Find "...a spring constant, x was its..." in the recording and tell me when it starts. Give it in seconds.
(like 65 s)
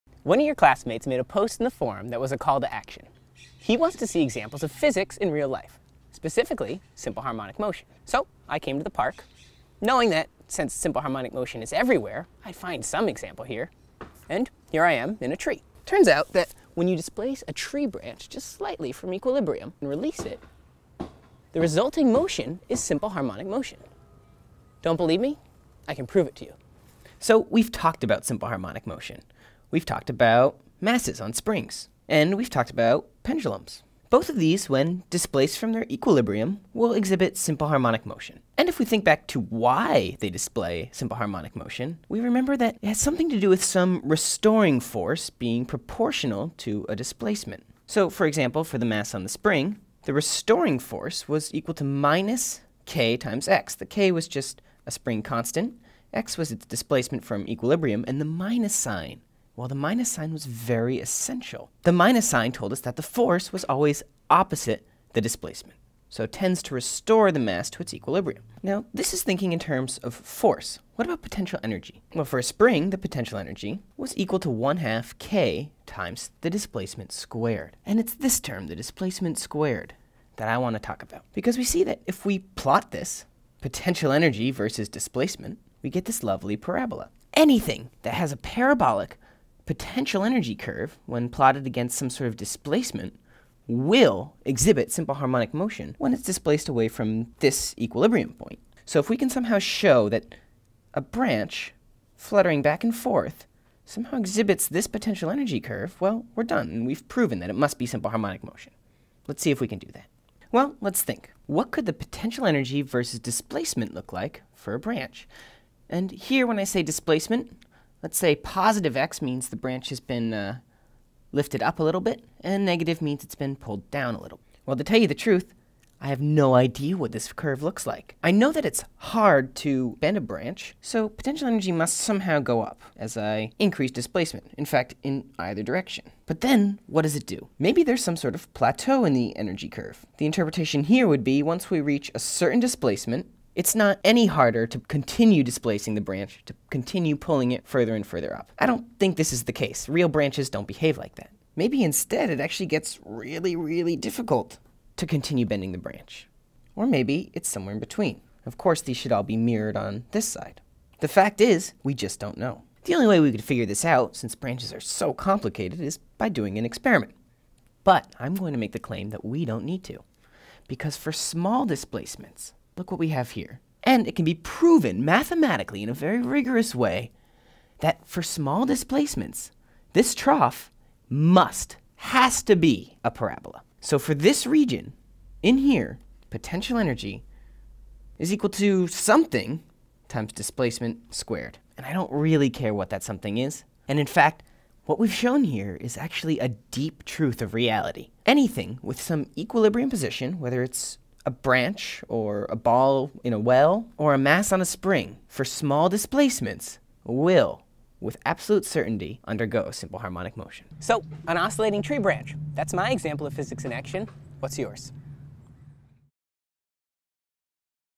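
54 s.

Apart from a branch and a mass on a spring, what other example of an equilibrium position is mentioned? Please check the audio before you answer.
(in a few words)
A ball in a well.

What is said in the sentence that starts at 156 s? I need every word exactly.
Or maybe it's somewhere in between.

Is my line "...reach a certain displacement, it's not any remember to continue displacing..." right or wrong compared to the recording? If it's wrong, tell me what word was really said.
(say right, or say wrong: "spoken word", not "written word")
wrong: "harder", not "remember".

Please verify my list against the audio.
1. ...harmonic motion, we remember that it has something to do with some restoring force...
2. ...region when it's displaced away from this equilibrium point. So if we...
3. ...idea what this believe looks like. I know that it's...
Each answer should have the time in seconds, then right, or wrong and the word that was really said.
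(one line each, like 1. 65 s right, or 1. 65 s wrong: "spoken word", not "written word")
1. 41 s right
2. 95 s wrong: "motion", not "region"
3. 126 s wrong: "curve", not "believe".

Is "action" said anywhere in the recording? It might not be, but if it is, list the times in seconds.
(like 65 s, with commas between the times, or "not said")
2 s, 213 s.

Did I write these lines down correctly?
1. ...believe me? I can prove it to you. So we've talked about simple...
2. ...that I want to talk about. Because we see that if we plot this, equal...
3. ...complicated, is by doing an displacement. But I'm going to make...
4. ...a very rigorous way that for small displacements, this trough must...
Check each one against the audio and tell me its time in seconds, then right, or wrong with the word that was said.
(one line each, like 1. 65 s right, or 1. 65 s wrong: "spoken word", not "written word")
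1. 24 s right
2. 80 s wrong: "potential", not "equal"
3. 165 s wrong: "experiment", not "displacement"
4. 175 s right.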